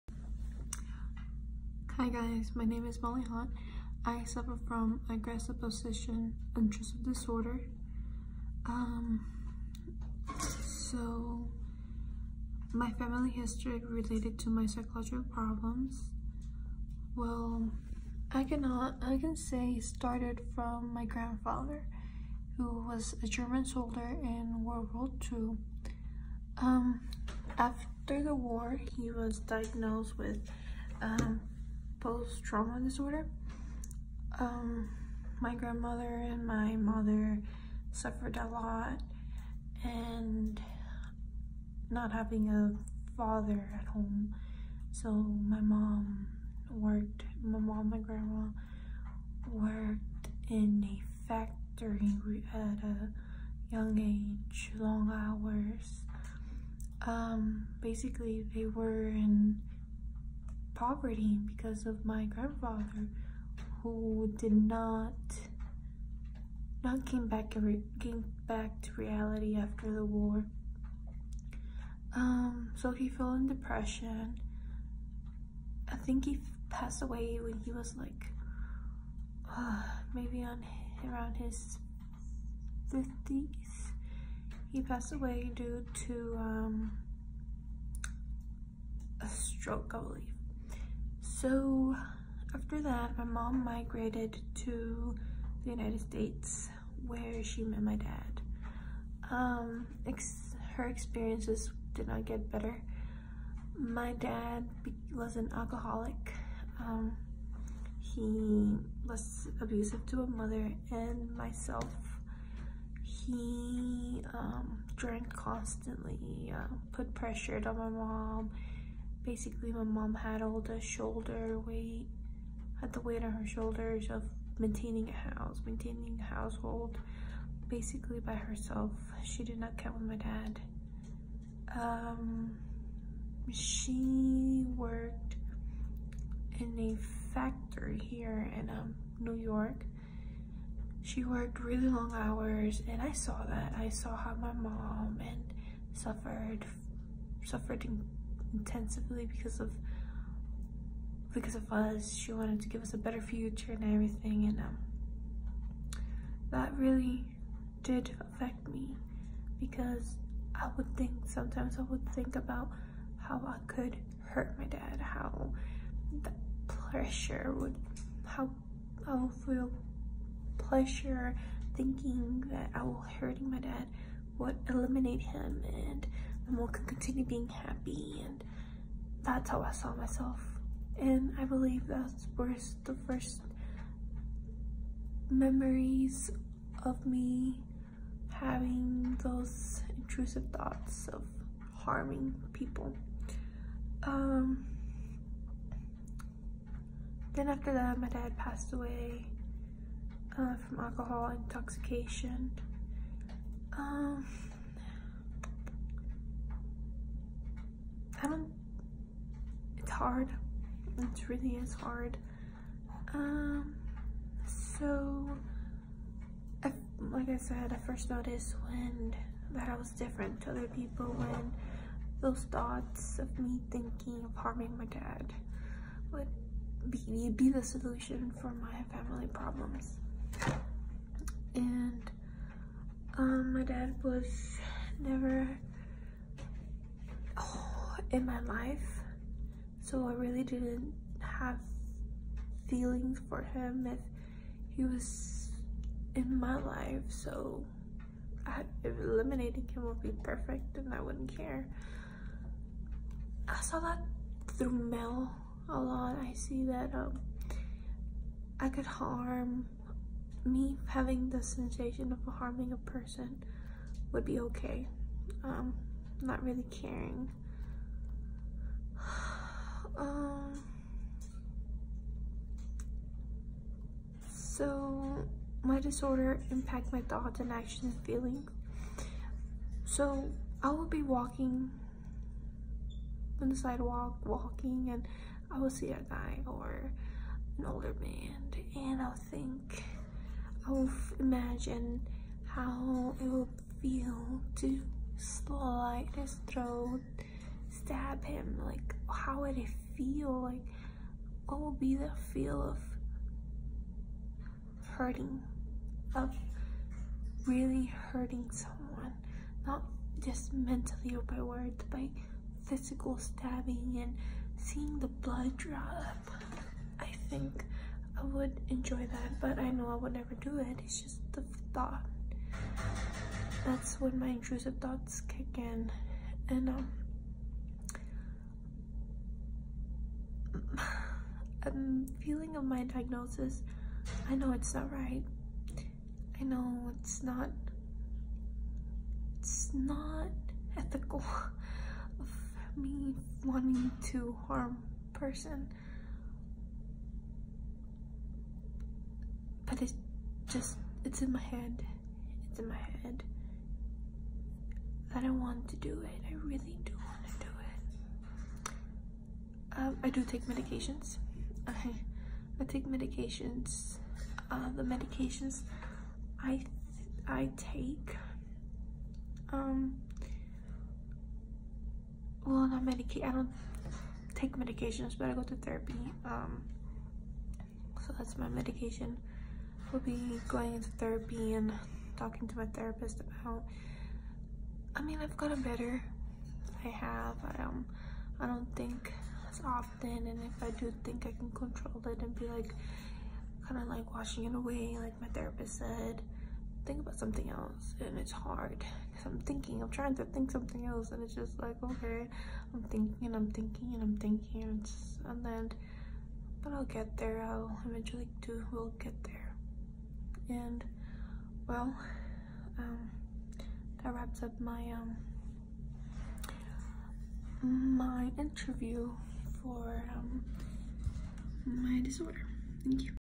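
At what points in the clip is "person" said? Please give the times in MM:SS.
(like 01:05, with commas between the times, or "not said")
04:22, 05:45.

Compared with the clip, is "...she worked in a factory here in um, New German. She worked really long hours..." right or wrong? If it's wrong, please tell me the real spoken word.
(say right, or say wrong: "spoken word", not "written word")
wrong: "York", not "German".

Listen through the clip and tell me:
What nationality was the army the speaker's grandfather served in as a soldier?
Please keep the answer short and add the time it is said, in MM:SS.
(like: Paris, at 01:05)
German, at 00:23.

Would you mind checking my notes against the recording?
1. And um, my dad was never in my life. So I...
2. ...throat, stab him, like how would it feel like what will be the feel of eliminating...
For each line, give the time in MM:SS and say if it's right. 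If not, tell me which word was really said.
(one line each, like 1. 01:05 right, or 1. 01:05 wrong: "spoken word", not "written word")
1. 03:51 right
2. 04:56 wrong: "hurting", not "eliminating".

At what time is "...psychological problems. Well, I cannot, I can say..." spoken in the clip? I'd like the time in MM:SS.
00:14.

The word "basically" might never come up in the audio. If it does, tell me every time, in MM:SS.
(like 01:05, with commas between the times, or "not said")
00:57, 01:59, 02:07.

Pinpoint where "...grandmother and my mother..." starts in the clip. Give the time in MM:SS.
00:35.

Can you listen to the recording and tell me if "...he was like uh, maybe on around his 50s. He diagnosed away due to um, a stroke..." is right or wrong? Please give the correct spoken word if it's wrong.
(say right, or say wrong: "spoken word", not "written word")
wrong: "passed", not "diagnosed".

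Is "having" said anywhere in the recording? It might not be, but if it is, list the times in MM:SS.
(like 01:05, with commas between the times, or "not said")
00:42, 03:08, 04:20.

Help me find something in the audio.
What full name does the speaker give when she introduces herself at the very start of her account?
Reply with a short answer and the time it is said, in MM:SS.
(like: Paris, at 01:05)
Molly Hunt, at 00:02.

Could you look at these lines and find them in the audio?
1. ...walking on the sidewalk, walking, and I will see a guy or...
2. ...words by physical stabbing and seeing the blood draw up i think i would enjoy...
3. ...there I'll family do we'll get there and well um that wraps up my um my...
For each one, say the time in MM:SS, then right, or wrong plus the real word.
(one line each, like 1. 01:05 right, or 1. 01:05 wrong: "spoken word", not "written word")
1. 04:41 right
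2. 05:11 right
3. 06:47 wrong: "eventually", not "family".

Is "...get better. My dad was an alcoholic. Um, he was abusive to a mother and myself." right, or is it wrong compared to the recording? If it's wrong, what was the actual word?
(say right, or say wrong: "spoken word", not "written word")
right.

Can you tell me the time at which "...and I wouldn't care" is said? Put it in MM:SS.
04:10.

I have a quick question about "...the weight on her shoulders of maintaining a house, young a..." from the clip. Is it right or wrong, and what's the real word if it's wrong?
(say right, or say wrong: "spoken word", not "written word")
wrong: "maintaining", not "young".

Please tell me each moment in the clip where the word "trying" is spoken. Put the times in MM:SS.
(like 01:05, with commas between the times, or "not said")
06:39.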